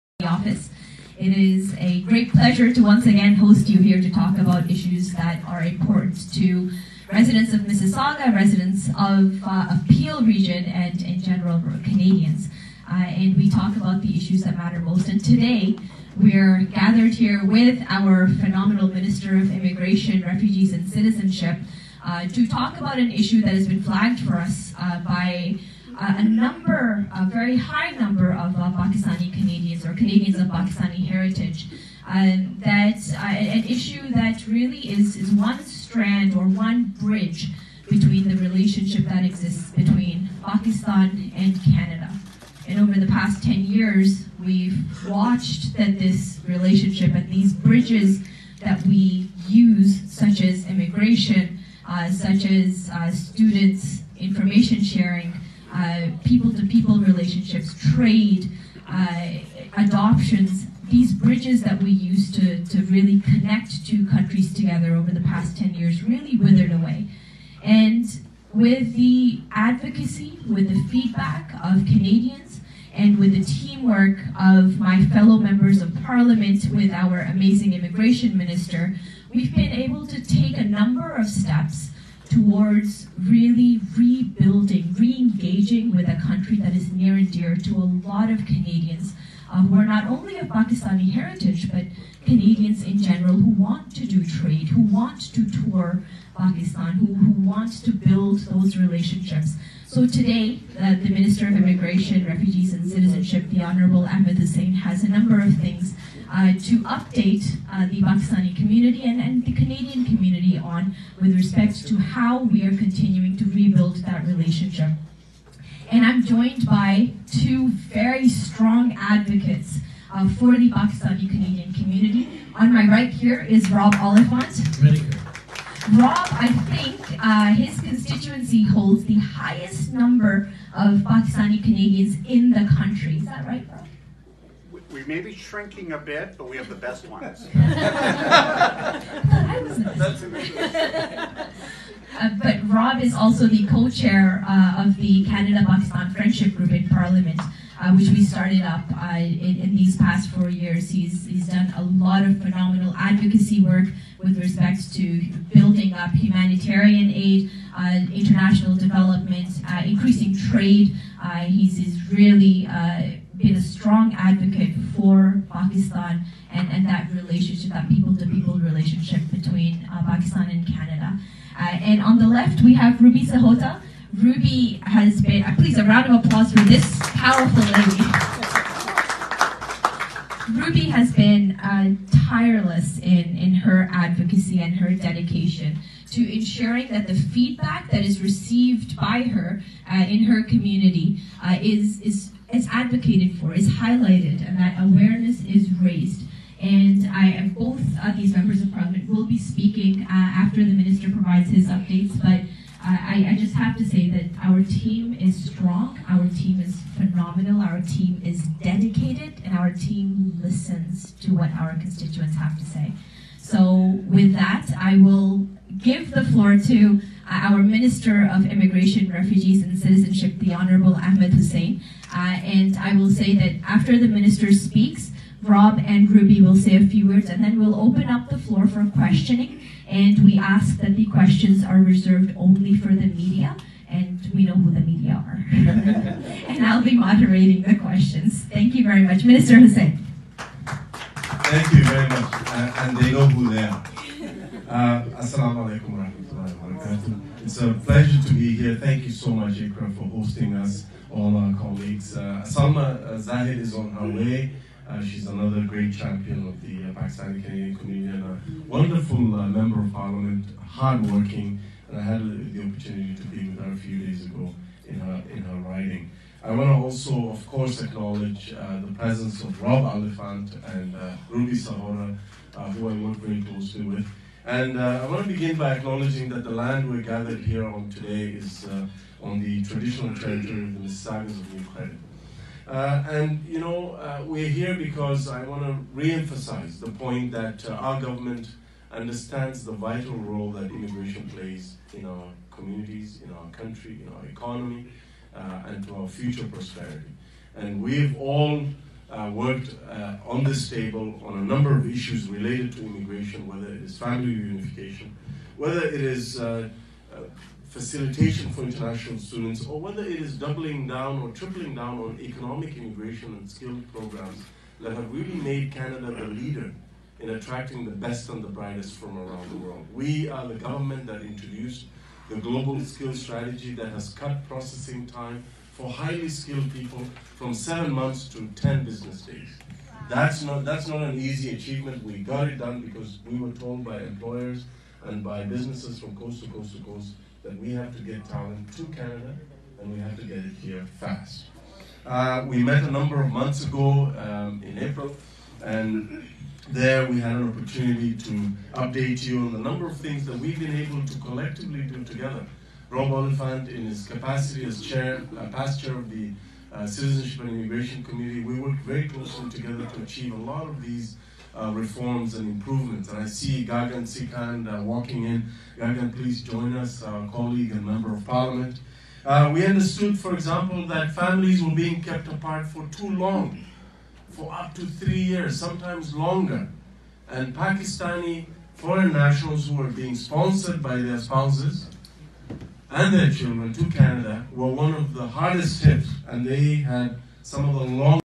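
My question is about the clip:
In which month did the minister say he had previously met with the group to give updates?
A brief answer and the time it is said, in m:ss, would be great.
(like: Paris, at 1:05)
April, at 5:44.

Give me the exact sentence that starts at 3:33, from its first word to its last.
So, with that, I will give the floor to uh, our Minister of Immigration, Refugees, and Citizenship, the Honorable Ahmed Hussen.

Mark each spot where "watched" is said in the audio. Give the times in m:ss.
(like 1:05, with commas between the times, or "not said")
0:45.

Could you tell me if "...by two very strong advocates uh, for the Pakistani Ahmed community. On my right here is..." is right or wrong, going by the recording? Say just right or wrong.
wrong.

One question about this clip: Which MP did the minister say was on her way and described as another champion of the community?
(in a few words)
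Salma Zahid.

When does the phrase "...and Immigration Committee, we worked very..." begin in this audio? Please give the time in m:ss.
5:57.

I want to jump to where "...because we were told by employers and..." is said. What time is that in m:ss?
5:32.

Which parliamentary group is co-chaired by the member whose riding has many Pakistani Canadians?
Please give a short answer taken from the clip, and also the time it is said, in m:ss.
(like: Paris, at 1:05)
Canada-Pakistan Friendship Group, at 2:25.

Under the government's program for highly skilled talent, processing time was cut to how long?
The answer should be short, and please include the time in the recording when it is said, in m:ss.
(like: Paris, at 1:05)
10 business days, at 5:28.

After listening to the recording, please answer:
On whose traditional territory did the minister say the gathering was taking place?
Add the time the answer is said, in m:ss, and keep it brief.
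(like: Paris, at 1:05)
Mississaugas of New Credit, at 4:40.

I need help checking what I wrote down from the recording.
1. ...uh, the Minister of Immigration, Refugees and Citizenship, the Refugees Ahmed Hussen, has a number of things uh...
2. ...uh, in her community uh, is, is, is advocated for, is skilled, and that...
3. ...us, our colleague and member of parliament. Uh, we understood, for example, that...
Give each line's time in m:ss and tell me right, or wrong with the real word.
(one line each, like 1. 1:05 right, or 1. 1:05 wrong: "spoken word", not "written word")
1. 1:40 wrong: "Honorable", not "Refugees"
2. 3:09 wrong: "highlighted", not "skilled"
3. 6:06 right.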